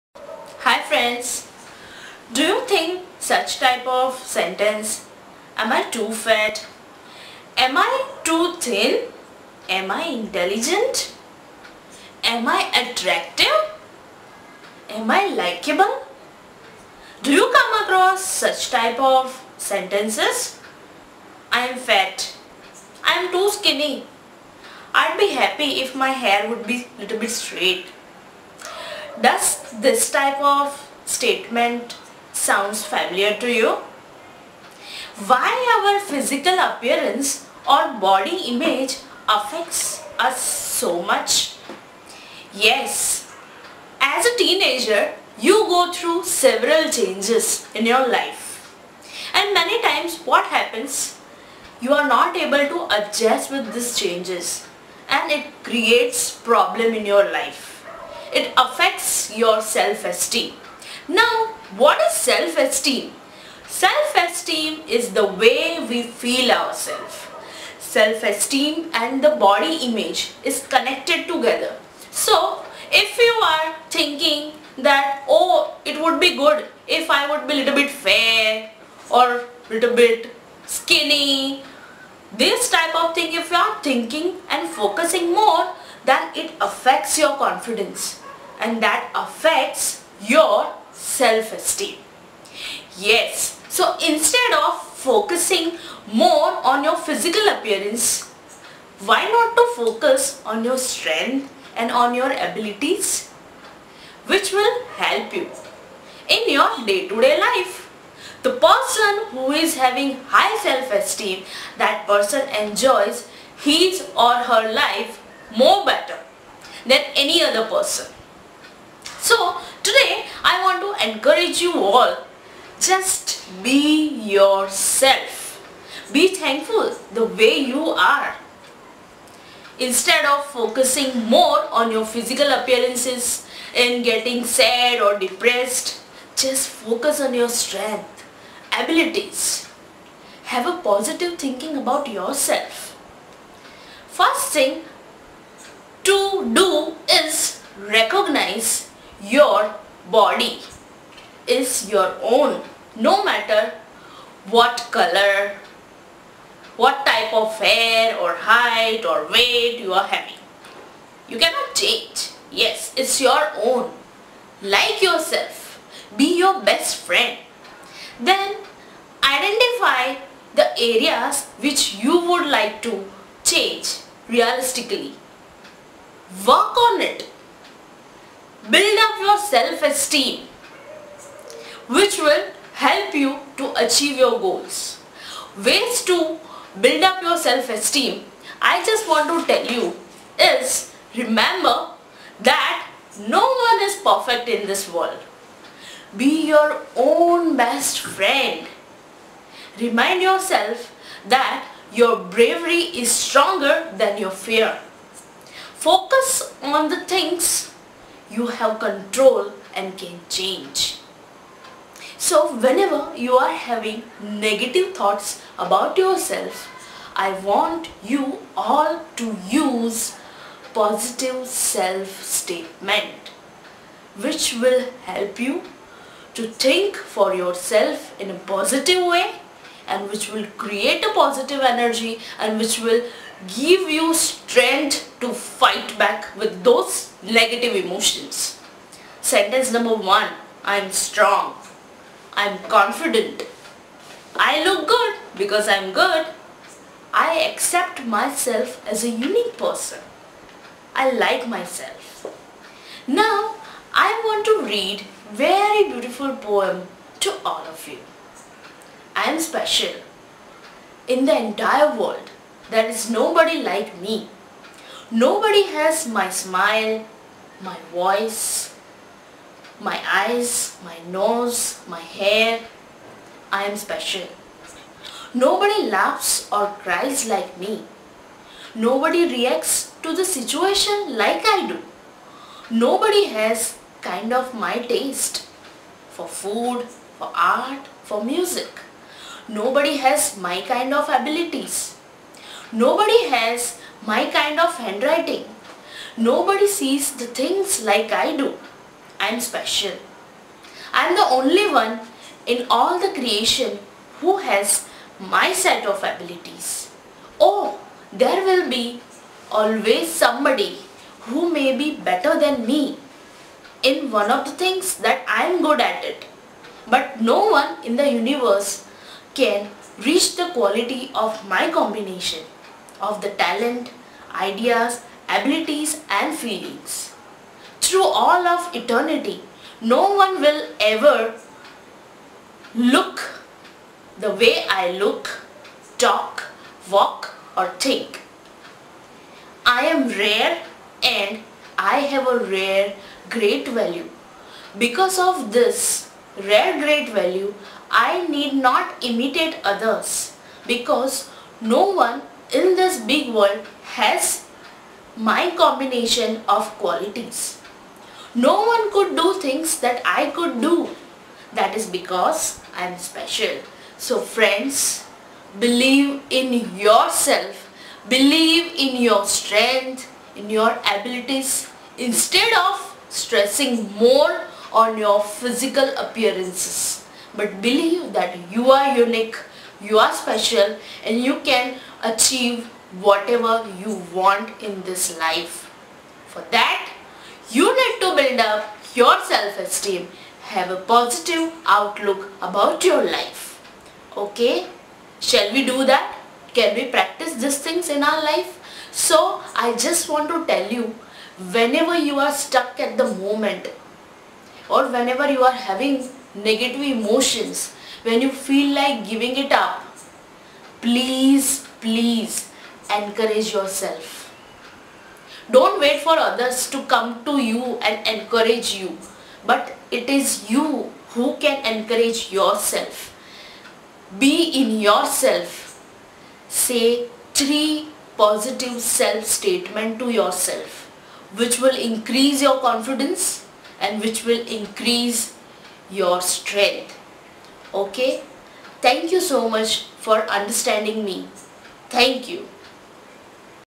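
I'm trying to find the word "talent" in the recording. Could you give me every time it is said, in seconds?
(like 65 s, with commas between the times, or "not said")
323 s.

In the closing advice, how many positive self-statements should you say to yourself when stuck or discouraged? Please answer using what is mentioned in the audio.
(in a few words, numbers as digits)
3.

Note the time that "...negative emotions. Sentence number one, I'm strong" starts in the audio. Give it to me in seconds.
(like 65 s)
237 s.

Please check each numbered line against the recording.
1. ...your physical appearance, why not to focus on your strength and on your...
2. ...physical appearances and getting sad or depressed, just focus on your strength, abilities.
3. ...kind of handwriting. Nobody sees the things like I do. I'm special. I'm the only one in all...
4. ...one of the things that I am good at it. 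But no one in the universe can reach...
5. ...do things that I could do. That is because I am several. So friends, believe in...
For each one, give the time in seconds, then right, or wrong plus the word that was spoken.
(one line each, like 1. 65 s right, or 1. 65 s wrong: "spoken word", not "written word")
1. 96 s right
2. 132 s right
3. 294 s right
4. 314 s right
5. 359 s wrong: "special", not "several".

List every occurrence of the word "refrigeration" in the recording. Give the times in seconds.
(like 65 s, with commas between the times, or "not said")
not said.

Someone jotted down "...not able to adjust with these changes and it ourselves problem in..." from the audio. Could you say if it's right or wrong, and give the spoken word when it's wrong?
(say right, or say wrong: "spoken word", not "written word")
wrong: "creates", not "ourselves".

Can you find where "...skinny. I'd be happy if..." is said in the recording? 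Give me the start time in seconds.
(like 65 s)
23 s.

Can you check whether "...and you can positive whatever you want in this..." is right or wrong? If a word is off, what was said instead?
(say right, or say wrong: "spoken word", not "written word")
wrong: "achieve", not "positive".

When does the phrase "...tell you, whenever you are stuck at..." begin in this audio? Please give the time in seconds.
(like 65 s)
400 s.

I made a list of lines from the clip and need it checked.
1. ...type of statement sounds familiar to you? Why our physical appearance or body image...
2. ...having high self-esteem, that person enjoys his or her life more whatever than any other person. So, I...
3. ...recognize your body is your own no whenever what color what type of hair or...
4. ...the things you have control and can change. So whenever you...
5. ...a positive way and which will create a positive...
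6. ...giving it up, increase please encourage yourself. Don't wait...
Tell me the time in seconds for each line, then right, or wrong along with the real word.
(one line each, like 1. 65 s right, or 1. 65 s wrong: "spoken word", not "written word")
1. 30 s right
2. 109 s wrong: "better", not "whatever"
3. 147 s wrong: "matter", not "whenever"
4. 206 s right
5. 228 s right
6. 409 s wrong: "please", not "increase".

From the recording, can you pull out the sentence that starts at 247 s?
I accept myself as a unique person.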